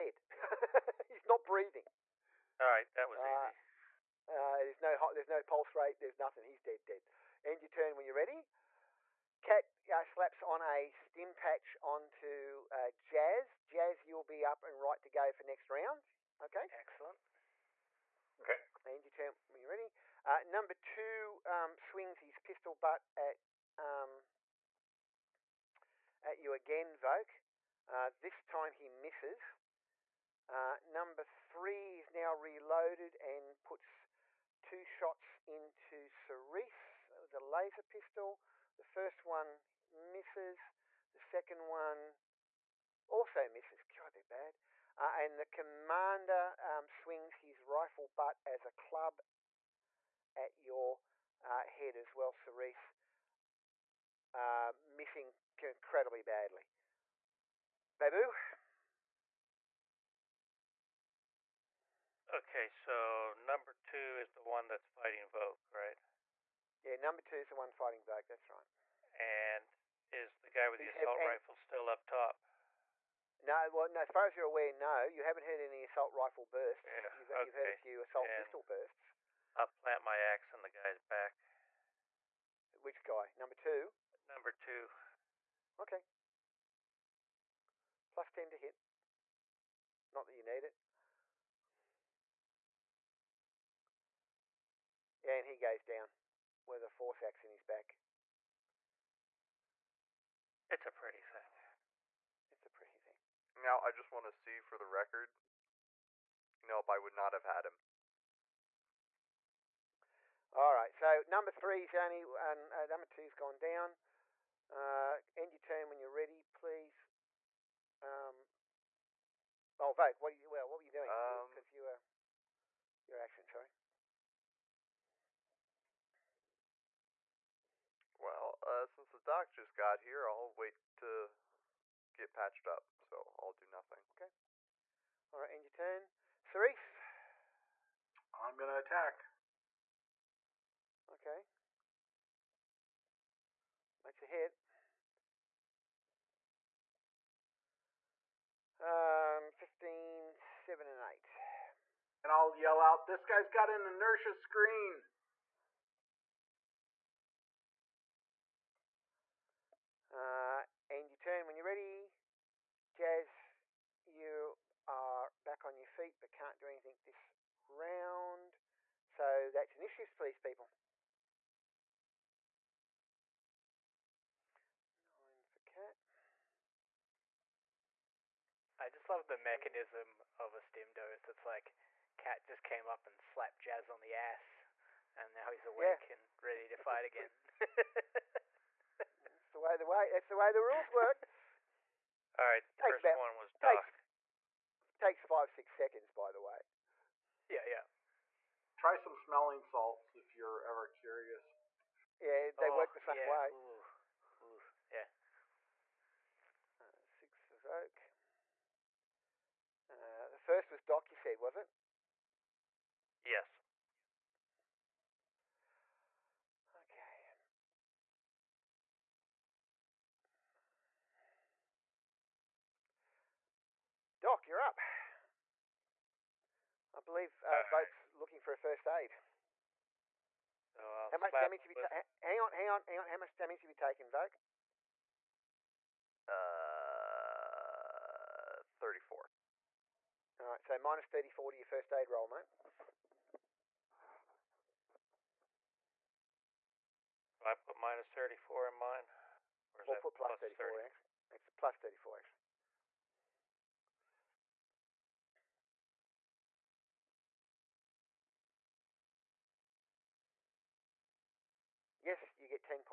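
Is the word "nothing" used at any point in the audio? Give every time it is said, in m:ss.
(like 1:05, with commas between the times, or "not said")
0:06, 2:13.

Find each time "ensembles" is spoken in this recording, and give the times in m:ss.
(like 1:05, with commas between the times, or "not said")
not said.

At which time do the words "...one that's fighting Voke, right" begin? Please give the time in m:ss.
1:04.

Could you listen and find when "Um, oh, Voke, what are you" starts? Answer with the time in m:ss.
1:58.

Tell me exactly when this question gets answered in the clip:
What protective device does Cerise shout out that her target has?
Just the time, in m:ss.
2:33.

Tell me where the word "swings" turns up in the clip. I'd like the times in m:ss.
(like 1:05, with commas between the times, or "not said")
0:21, 0:47.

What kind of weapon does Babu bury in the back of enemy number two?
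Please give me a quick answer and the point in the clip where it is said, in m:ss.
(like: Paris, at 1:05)
force axe, at 1:36.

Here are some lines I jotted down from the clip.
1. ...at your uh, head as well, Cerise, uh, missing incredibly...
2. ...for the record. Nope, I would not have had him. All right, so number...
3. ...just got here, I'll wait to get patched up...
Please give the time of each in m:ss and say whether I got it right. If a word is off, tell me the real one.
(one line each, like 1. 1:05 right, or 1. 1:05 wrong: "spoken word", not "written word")
1. 0:50 right
2. 1:44 right
3. 2:09 right.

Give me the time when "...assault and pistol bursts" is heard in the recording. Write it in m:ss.
1:17.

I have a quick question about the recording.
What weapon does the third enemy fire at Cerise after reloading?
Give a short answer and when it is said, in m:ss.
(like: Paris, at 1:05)
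laser pistol, at 0:37.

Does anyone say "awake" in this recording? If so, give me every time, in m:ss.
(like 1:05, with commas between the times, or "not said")
3:05.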